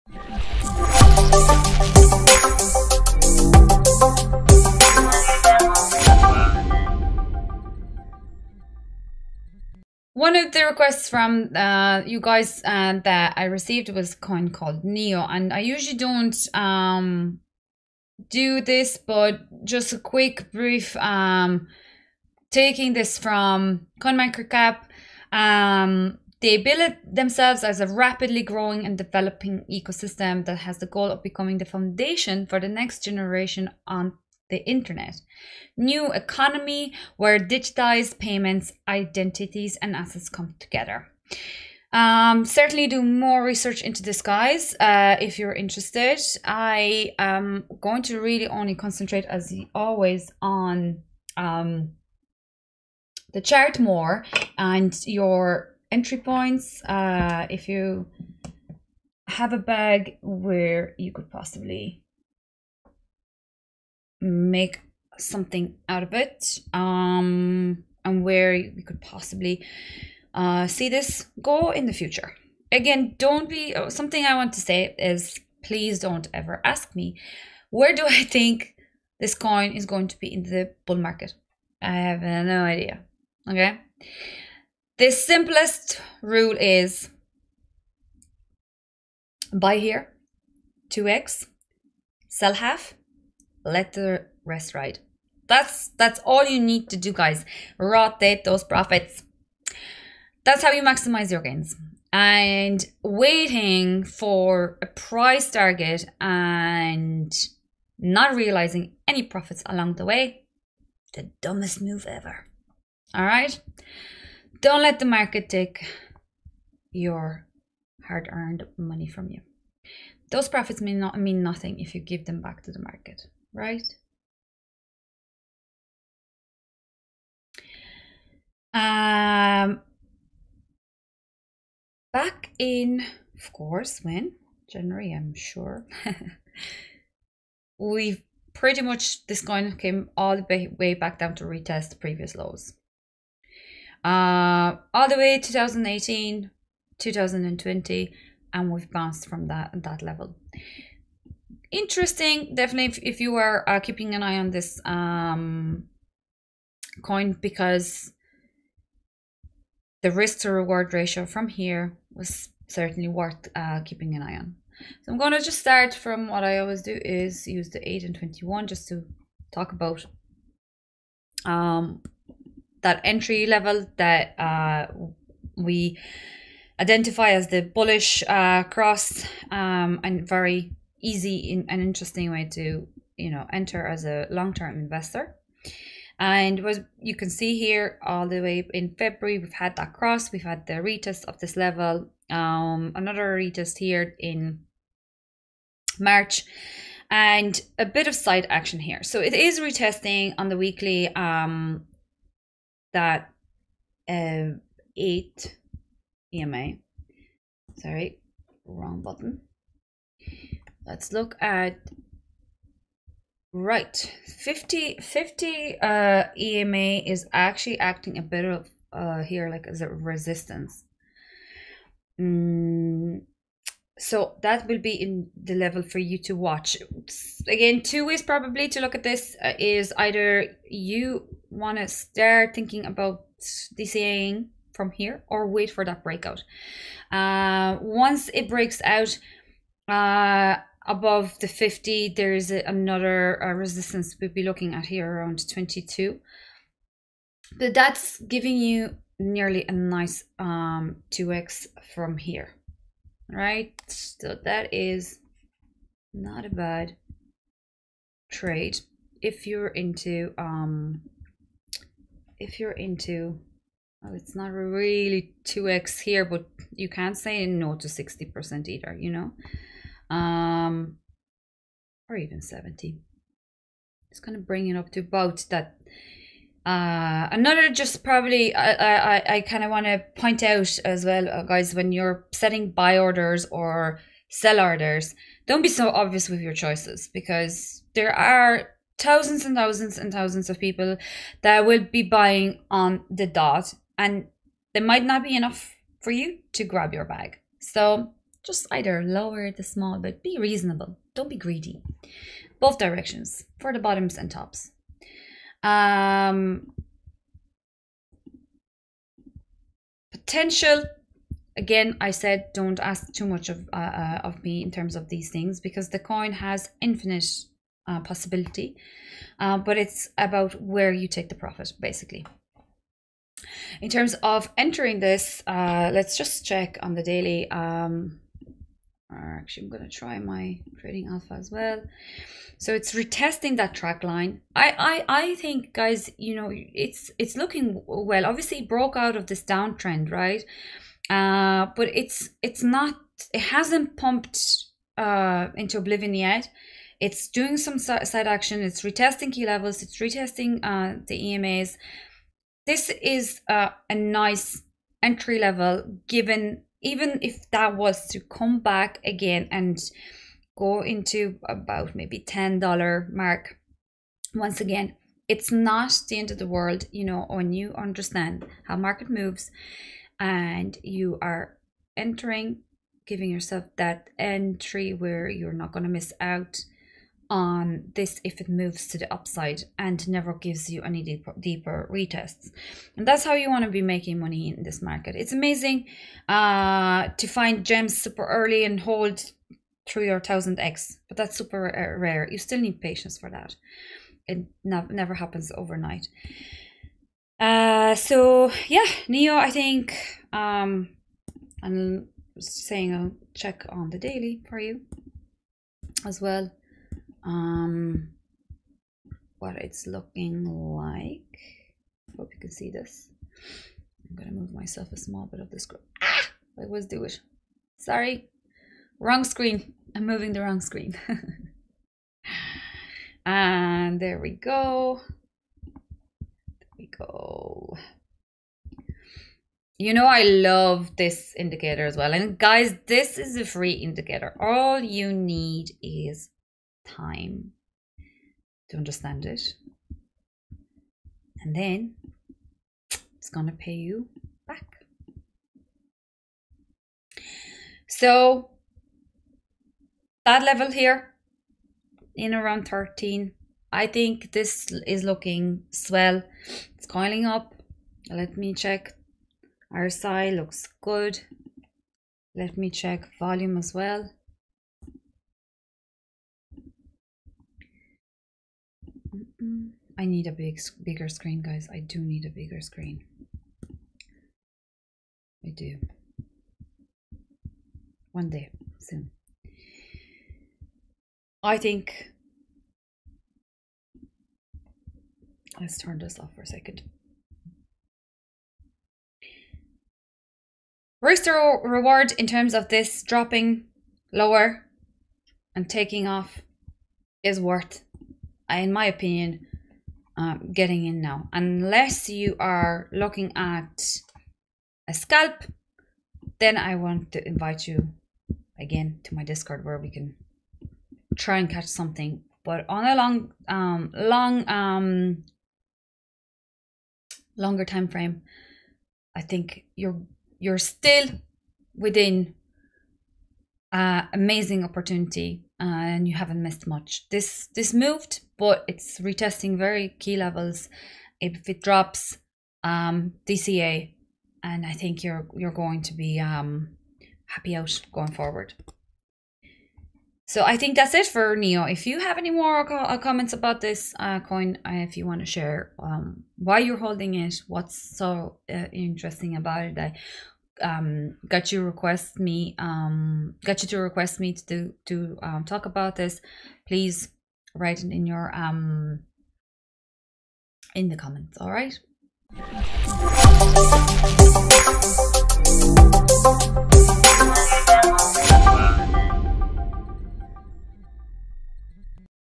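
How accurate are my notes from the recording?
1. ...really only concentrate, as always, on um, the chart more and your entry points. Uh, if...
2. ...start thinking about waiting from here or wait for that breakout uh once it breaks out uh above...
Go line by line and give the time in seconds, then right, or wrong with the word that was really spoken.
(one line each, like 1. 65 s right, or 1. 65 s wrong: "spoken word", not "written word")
1. 48 s right
2. 231 s wrong: "dcing", not "waiting".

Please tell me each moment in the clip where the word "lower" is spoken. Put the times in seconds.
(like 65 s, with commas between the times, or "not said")
299 s, 494 s.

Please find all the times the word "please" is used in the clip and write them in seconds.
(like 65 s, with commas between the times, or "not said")
75 s, 556 s.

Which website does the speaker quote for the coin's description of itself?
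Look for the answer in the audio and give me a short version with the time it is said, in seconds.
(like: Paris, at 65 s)
CoinMarketCap, at 23 s.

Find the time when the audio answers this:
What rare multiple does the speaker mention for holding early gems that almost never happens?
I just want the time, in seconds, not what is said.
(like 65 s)
390 s.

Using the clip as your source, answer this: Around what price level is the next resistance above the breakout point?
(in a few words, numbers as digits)
22.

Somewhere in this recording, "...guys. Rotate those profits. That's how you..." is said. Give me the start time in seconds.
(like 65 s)
97 s.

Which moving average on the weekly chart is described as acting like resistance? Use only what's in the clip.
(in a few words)
50 EMA.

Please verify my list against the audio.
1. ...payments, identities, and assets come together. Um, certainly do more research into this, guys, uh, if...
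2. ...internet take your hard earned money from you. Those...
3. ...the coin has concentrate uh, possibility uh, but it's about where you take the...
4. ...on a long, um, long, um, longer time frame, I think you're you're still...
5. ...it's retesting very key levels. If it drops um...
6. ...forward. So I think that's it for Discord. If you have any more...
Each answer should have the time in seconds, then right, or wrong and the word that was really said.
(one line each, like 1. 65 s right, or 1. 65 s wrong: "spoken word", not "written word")
1. 38 s right
2. 115 s wrong: "market", not "internet"
3. 315 s wrong: "infinite", not "concentrate"
4. 512 s right
5. 528 s right
6. 538 s wrong: "Neo", not "Discord".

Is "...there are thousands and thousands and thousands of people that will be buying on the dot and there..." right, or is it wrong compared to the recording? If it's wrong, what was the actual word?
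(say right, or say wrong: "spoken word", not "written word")
right.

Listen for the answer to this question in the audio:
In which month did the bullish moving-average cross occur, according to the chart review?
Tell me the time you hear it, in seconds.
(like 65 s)
188 s.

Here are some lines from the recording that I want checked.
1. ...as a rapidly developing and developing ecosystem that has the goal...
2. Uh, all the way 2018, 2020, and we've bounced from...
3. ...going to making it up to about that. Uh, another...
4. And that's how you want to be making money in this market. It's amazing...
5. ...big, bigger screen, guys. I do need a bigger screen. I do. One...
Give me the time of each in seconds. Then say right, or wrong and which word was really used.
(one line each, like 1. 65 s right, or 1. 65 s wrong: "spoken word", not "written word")
1. 27 s wrong: "growing", not "developing"
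2. 144 s right
3. 274 s wrong: "bring", not "making"
4. 382 s right
5. 470 s right.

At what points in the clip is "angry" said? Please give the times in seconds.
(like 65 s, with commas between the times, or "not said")
not said.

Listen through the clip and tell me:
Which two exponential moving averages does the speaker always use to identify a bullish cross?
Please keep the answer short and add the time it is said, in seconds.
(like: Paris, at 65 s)
8 and 21, at 167 s.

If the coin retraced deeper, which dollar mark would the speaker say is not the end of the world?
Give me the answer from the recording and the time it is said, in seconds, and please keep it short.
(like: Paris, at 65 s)
$10, at 362 s.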